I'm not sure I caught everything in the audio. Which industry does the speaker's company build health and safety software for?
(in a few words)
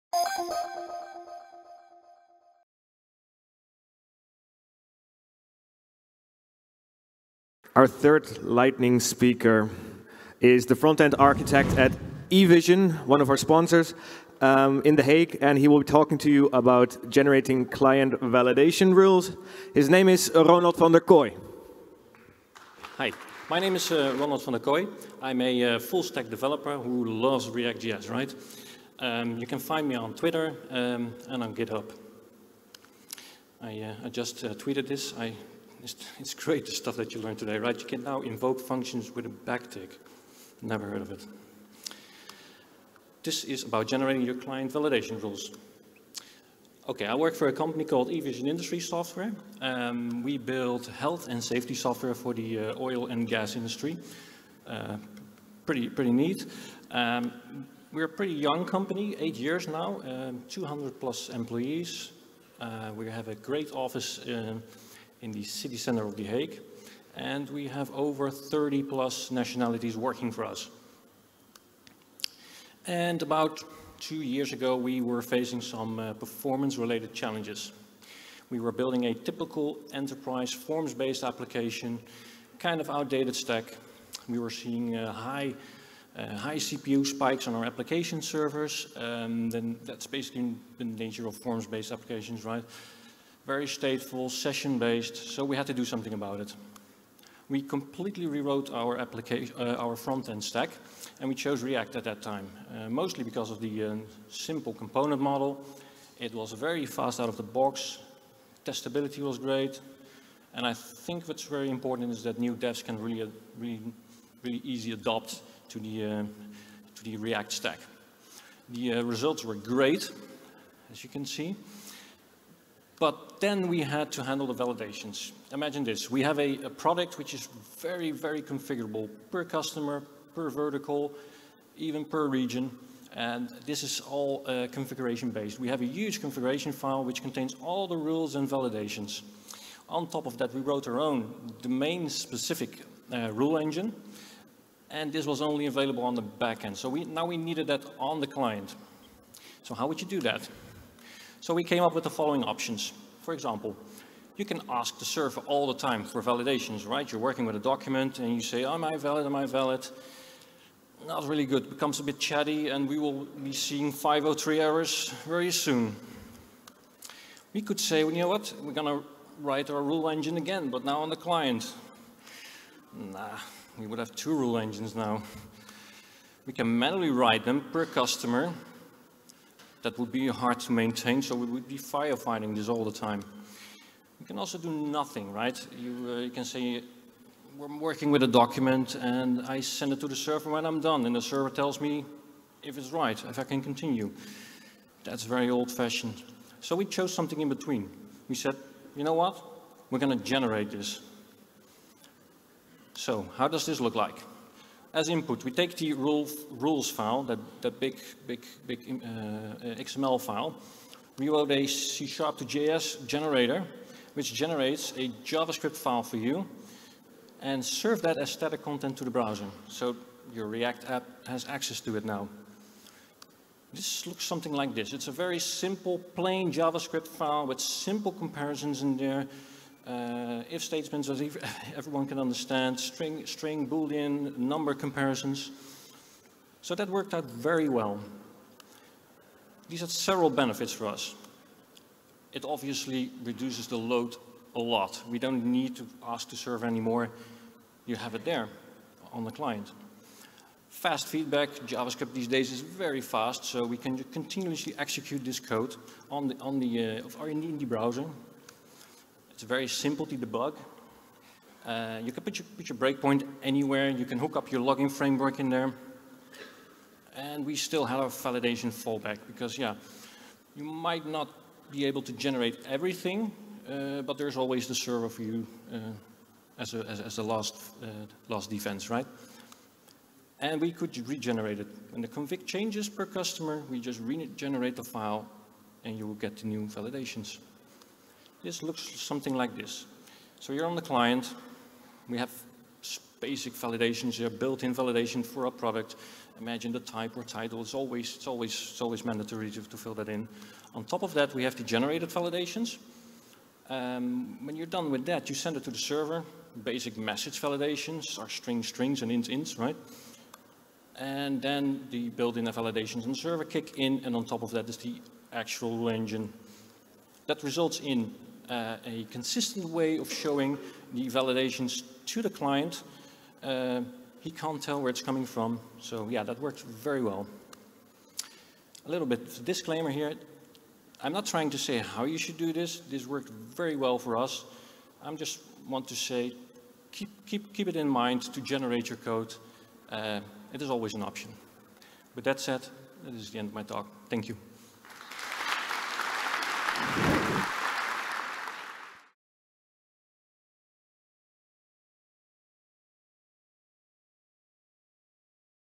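oil and gas.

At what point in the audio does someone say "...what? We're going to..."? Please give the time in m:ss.
3:19.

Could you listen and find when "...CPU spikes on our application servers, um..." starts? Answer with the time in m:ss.
1:26.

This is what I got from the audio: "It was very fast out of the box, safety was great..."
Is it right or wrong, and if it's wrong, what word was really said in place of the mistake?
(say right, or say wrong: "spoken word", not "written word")
wrong: "testability", not "safety".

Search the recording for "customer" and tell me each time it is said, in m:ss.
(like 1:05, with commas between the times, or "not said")
2:09, 2:57, 4:43.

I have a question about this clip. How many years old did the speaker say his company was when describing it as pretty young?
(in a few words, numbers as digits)
8.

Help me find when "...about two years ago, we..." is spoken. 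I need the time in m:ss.
1:13.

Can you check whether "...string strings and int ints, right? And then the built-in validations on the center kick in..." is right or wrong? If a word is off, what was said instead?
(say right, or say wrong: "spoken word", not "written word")
wrong: "server", not "center".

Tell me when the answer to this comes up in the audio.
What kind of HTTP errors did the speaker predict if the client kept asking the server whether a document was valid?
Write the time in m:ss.
2:43.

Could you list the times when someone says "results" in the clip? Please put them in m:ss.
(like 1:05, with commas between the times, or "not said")
1:59, 5:17.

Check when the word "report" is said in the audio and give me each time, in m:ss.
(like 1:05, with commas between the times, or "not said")
not said.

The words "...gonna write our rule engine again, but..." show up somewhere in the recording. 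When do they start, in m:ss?
2:48.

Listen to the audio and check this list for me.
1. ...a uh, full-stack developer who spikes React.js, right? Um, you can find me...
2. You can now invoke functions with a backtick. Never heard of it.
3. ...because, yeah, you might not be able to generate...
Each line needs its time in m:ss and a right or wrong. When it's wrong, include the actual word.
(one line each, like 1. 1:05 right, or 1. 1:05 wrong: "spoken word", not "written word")
1. 0:25 wrong: "loves", not "spikes"
2. 0:37 right
3. 4:29 right.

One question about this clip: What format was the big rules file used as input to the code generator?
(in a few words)
XML.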